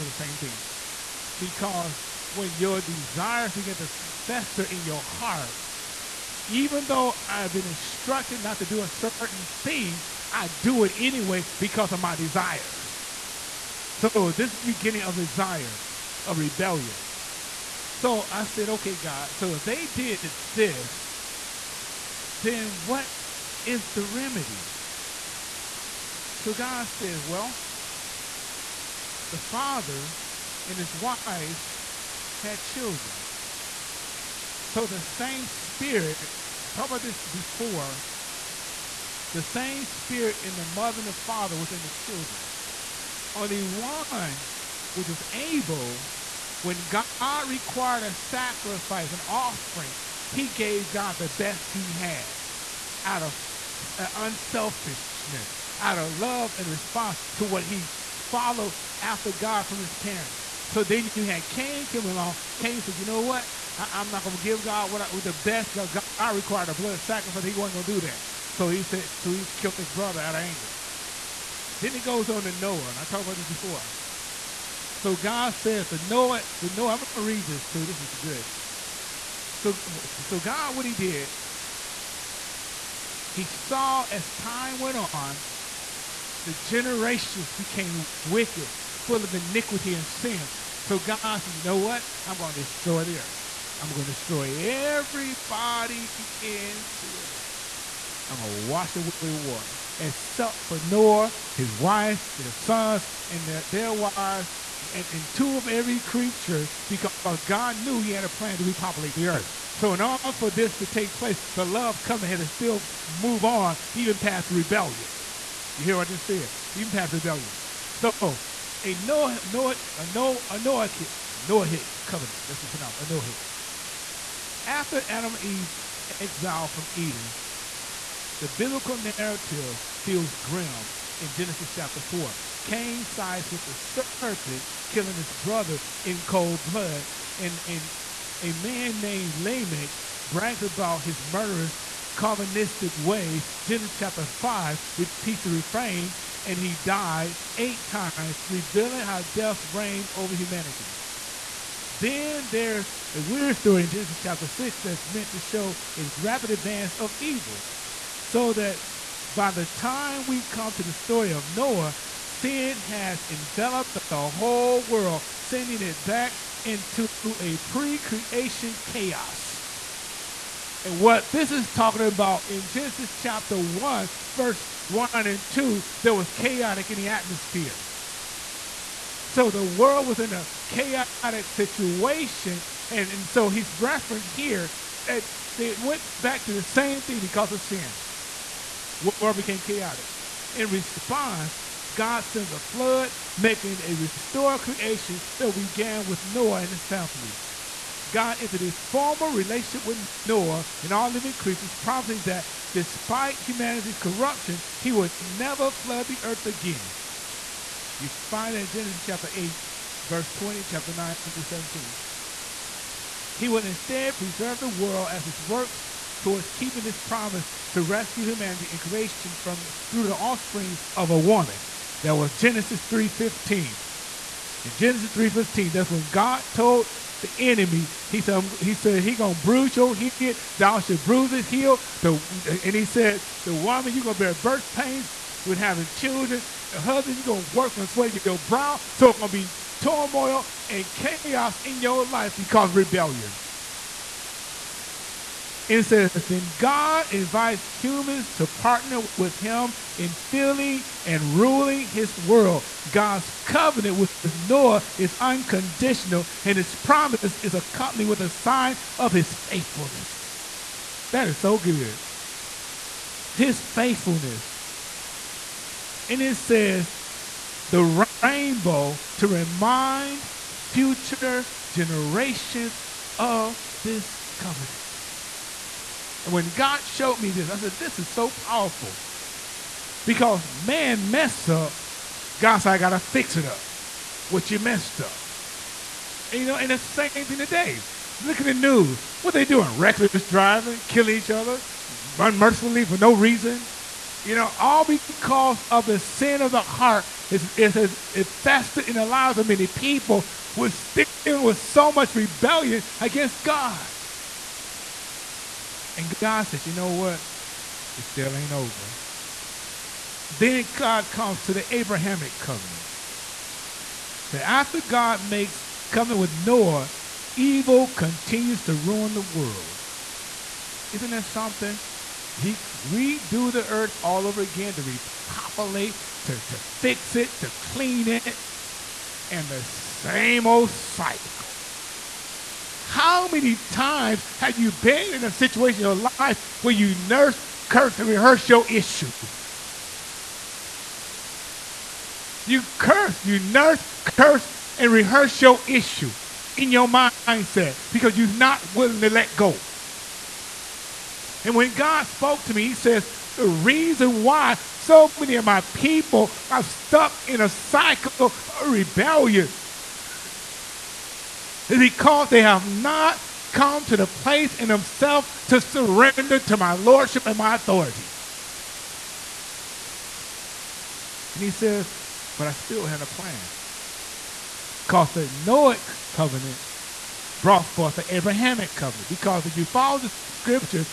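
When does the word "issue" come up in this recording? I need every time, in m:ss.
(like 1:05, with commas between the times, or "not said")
5:38, 5:45.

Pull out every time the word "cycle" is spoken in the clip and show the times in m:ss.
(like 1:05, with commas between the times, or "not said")
5:30, 5:57.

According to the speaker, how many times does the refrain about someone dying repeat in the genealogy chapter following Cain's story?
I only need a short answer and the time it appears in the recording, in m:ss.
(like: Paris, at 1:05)
8, at 2:27.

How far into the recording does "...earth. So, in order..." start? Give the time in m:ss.
1:49.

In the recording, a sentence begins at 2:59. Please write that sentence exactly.
So the world was in a chaotic situation.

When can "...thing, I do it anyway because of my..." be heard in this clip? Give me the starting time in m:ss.
0:09.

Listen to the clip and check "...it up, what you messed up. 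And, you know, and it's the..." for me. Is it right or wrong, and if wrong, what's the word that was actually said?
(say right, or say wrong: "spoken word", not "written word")
right.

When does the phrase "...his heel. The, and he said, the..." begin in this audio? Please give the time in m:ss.
3:51.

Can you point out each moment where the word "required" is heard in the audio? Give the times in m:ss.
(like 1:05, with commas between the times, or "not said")
0:47, 1:06.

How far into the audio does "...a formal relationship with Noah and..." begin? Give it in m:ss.
3:18.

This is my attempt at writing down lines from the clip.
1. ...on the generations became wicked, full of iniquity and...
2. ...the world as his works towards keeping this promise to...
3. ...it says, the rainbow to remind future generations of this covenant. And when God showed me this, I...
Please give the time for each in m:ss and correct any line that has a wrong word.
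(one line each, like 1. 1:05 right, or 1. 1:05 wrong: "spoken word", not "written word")
1. 1:25 right
2. 3:34 right
3. 4:26 right.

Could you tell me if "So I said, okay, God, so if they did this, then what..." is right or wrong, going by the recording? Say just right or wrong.
right.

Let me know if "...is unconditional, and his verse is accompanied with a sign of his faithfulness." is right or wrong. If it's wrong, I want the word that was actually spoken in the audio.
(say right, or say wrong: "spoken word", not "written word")
wrong: "promise", not "verse".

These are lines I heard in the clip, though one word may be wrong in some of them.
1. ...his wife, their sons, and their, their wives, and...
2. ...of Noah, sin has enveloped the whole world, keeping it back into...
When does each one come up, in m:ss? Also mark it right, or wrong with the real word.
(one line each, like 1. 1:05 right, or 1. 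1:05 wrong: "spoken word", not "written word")
1. 1:41 right
2. 2:41 wrong: "sending", not "keeping".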